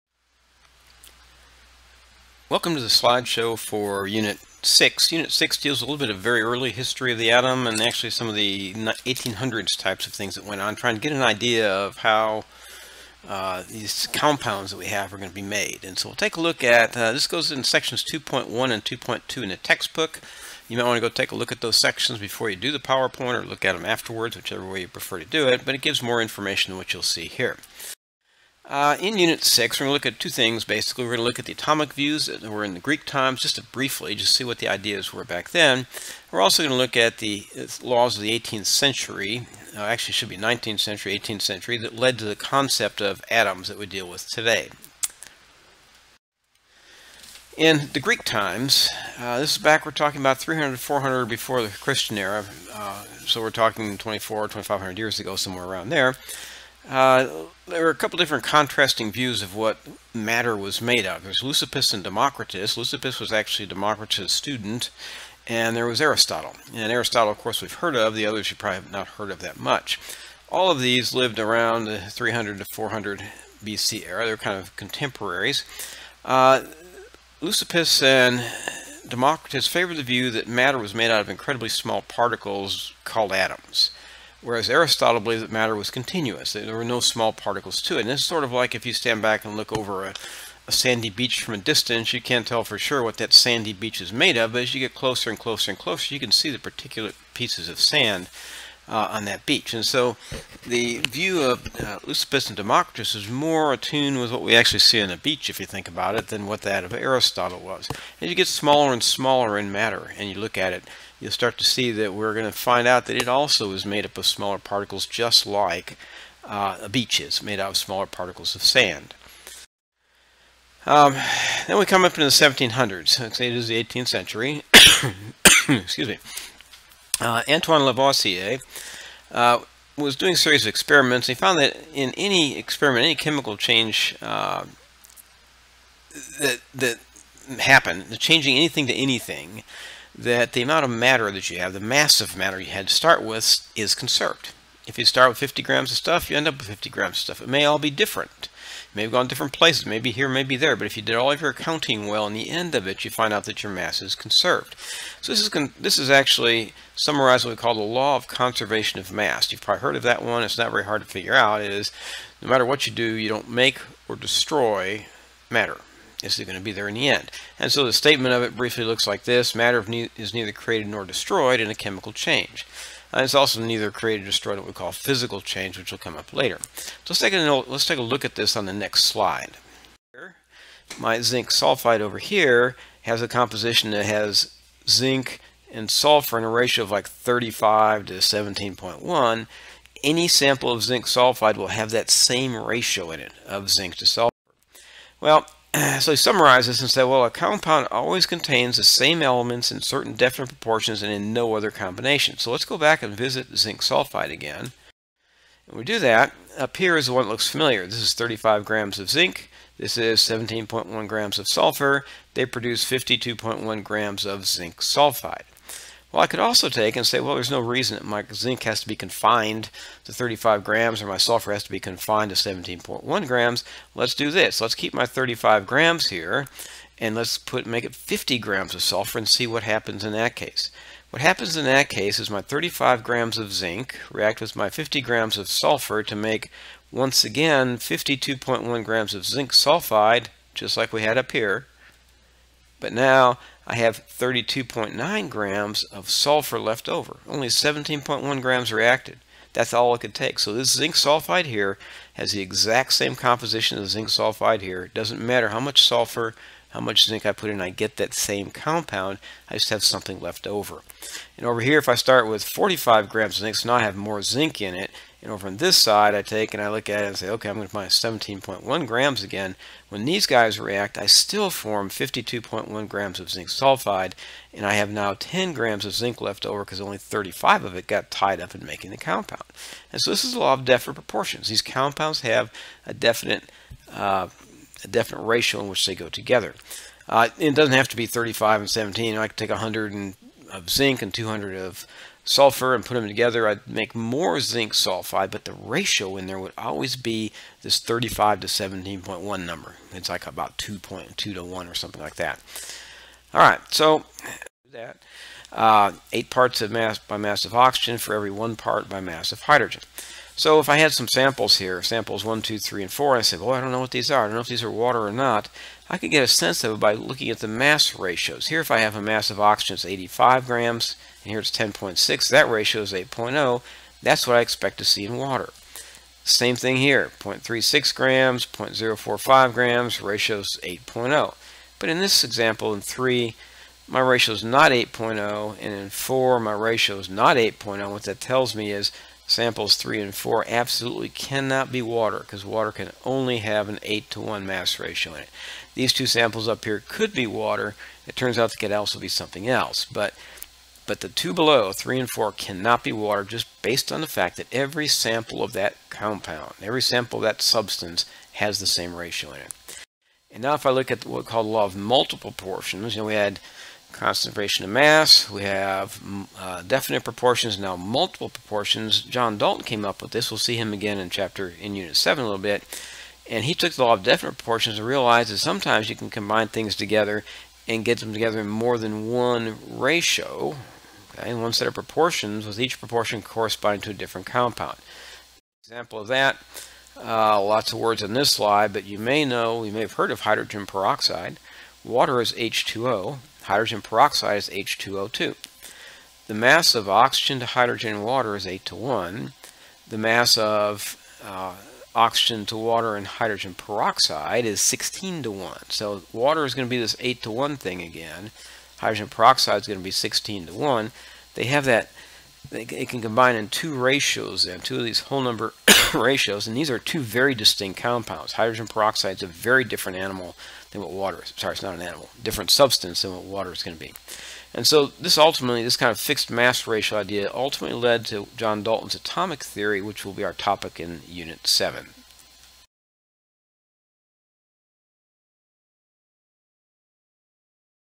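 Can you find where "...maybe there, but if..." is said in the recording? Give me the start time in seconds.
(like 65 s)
150 s.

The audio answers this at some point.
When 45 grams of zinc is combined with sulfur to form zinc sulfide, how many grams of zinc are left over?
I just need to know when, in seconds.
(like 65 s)
275 s.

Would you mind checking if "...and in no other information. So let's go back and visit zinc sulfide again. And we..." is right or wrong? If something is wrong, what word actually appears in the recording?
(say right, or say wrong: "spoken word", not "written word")
wrong: "combination", not "information".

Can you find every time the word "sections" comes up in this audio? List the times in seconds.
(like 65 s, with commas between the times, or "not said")
17 s, 21 s.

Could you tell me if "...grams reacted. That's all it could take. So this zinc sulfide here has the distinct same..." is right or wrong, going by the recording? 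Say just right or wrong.
wrong.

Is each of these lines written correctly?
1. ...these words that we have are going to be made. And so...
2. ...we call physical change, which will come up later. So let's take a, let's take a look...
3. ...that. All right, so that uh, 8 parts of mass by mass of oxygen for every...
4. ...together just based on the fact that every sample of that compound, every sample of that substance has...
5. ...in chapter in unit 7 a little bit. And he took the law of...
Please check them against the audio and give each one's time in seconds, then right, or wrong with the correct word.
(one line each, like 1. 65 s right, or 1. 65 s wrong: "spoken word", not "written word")
1. 13 s wrong: "compounds", not "words"
2. 174 s right
3. 302 s right
4. 352 s wrong: "water", not "together"
5. 370 s right.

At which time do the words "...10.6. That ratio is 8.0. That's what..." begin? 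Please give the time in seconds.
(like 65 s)
321 s.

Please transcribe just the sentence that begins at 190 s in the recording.
Any sample of zinc sulfide will have that same ratio in it of zinc to sulfur.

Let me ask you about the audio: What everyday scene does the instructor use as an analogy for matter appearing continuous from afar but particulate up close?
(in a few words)
a sandy beach.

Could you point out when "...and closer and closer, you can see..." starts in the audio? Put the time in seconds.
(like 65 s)
95 s.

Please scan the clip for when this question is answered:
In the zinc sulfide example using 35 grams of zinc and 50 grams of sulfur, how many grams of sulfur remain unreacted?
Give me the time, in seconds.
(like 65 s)
244 s.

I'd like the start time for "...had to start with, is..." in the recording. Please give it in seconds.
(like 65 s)
142 s.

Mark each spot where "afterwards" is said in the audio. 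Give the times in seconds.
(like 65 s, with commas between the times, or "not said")
23 s.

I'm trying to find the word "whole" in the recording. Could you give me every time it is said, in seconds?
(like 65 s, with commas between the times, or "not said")
415 s.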